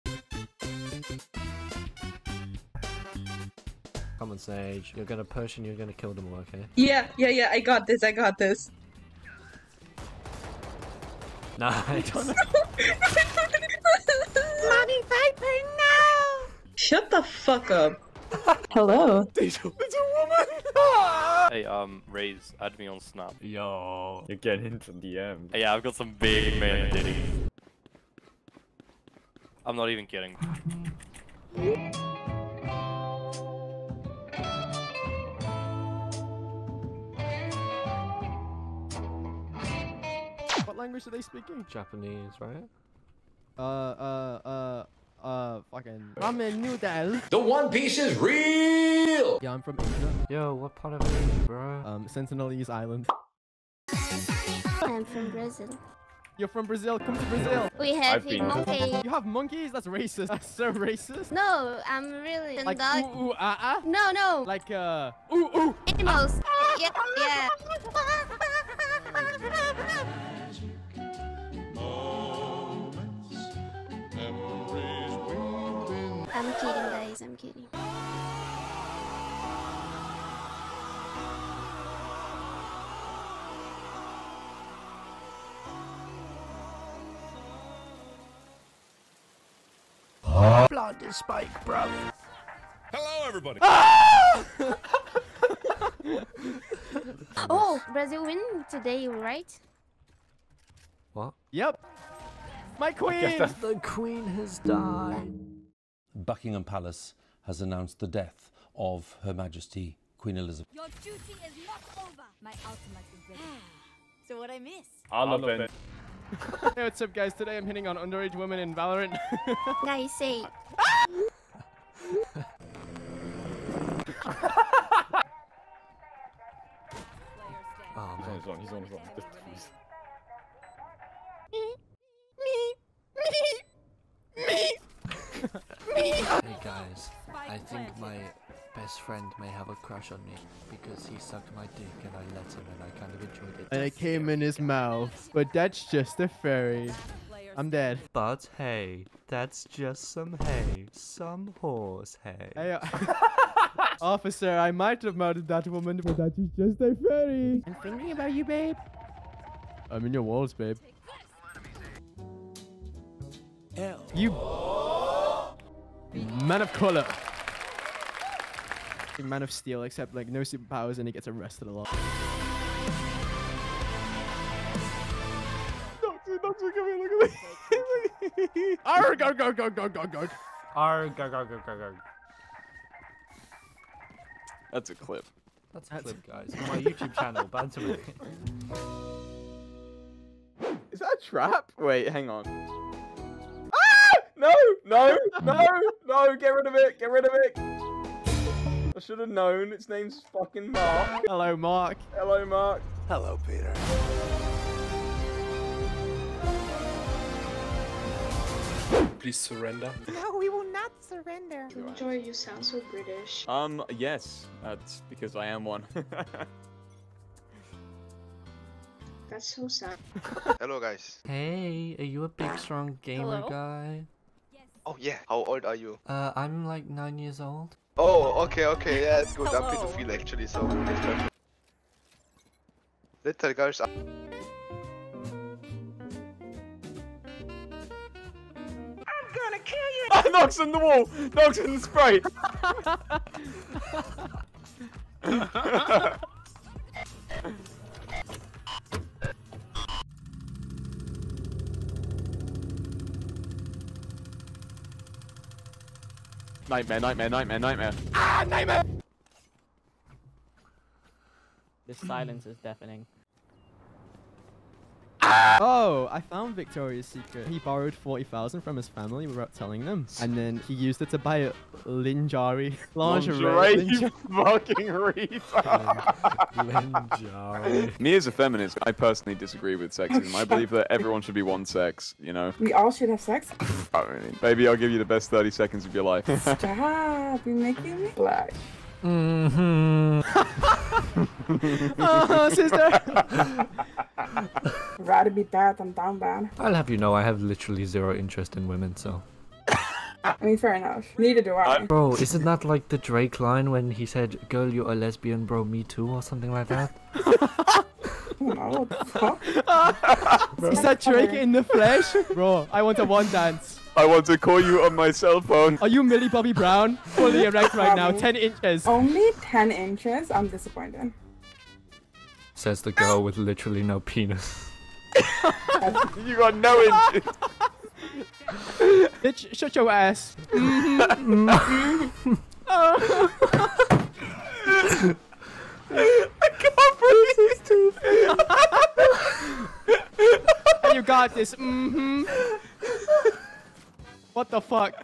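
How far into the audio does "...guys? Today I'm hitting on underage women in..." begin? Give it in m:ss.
1:57.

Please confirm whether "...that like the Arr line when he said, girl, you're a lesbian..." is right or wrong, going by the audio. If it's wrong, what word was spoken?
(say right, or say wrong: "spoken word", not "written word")
wrong: "Drake", not "Arr".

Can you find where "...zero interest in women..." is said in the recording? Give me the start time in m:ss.
4:57.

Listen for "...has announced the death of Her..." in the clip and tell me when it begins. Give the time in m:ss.
1:47.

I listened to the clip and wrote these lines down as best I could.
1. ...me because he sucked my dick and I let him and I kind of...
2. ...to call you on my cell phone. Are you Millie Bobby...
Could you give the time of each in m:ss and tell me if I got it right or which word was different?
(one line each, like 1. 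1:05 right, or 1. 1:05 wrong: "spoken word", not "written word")
1. 2:20 right
2. 5:14 right.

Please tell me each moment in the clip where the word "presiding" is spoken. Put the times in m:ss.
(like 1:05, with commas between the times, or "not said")
not said.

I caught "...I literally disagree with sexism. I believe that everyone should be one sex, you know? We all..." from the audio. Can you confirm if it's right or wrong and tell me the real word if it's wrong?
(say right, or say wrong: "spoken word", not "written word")
wrong: "personally", not "literally".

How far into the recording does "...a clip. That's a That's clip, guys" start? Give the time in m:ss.
3:04.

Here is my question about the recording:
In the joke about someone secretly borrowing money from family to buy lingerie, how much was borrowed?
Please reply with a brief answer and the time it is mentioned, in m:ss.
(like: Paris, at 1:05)
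40,000, at 4:27.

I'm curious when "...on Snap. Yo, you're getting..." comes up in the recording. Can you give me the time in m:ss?
0:22.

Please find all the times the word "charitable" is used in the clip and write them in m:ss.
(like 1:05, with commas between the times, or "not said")
not said.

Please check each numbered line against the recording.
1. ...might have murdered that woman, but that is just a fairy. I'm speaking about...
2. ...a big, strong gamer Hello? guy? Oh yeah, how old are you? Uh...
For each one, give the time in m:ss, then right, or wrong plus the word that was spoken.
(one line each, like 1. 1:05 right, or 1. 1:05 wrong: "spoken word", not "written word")
1. 2:34 wrong: "thinking", not "speaking"
2. 3:42 right.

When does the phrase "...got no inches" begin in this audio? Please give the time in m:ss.
5:26.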